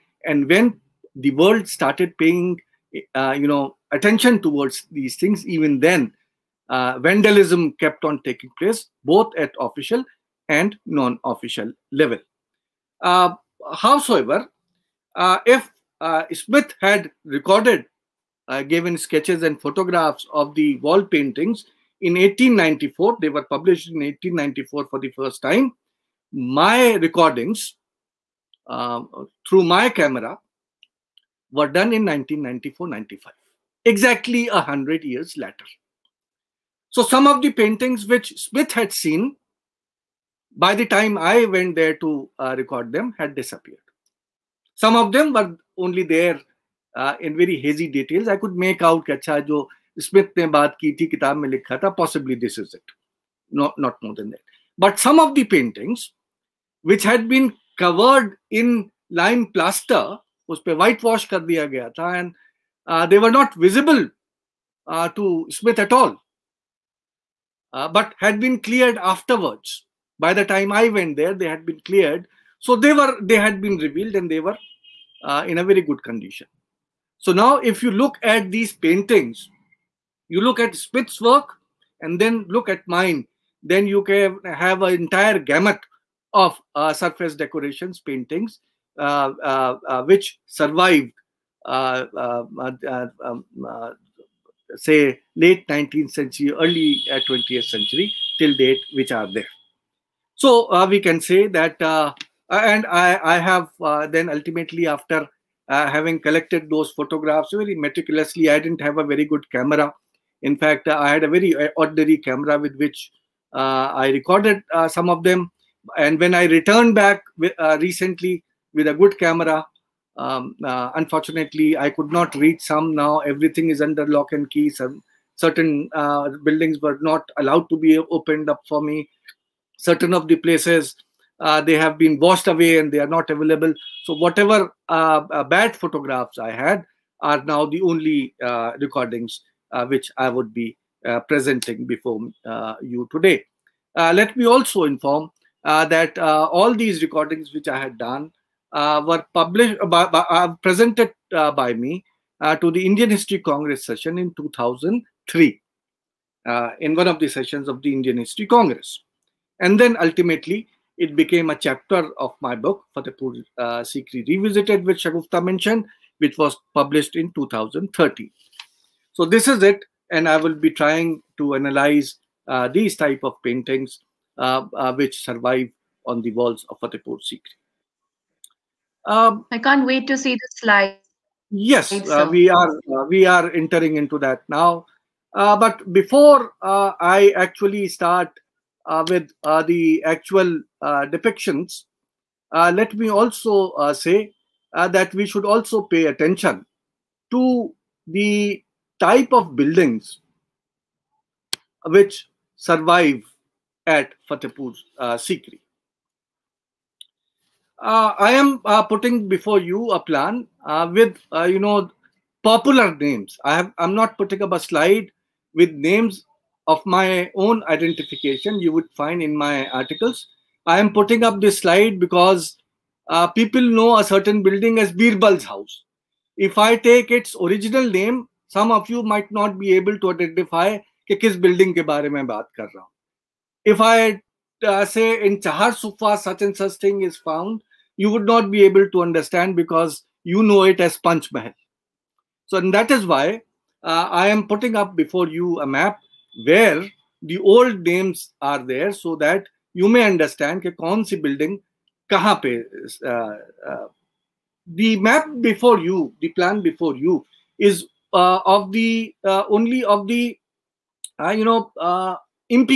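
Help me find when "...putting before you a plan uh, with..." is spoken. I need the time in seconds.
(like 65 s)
208 s.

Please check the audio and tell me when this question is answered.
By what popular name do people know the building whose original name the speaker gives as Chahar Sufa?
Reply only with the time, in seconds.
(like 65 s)
240 s.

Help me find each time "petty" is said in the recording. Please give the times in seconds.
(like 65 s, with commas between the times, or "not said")
not said.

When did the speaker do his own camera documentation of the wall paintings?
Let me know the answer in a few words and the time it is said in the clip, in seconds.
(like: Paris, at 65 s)
1994-95, at 32 s.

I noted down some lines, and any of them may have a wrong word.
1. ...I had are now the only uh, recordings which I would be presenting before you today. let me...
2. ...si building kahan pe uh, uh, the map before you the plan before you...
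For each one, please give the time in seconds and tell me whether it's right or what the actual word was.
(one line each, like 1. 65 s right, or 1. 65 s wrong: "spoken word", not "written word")
1. 136 s right
2. 251 s right.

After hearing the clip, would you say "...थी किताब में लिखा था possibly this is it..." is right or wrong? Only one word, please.
right.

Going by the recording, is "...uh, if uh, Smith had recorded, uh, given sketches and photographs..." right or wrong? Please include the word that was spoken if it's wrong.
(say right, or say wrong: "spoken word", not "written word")
right.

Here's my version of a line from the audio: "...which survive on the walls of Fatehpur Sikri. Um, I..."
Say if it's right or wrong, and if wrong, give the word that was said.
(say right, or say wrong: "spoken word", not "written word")
right.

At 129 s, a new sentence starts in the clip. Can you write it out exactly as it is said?
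Certain of the places uh, they have been washed away and they are not available.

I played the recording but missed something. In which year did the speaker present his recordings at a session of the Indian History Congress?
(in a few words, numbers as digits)
2003.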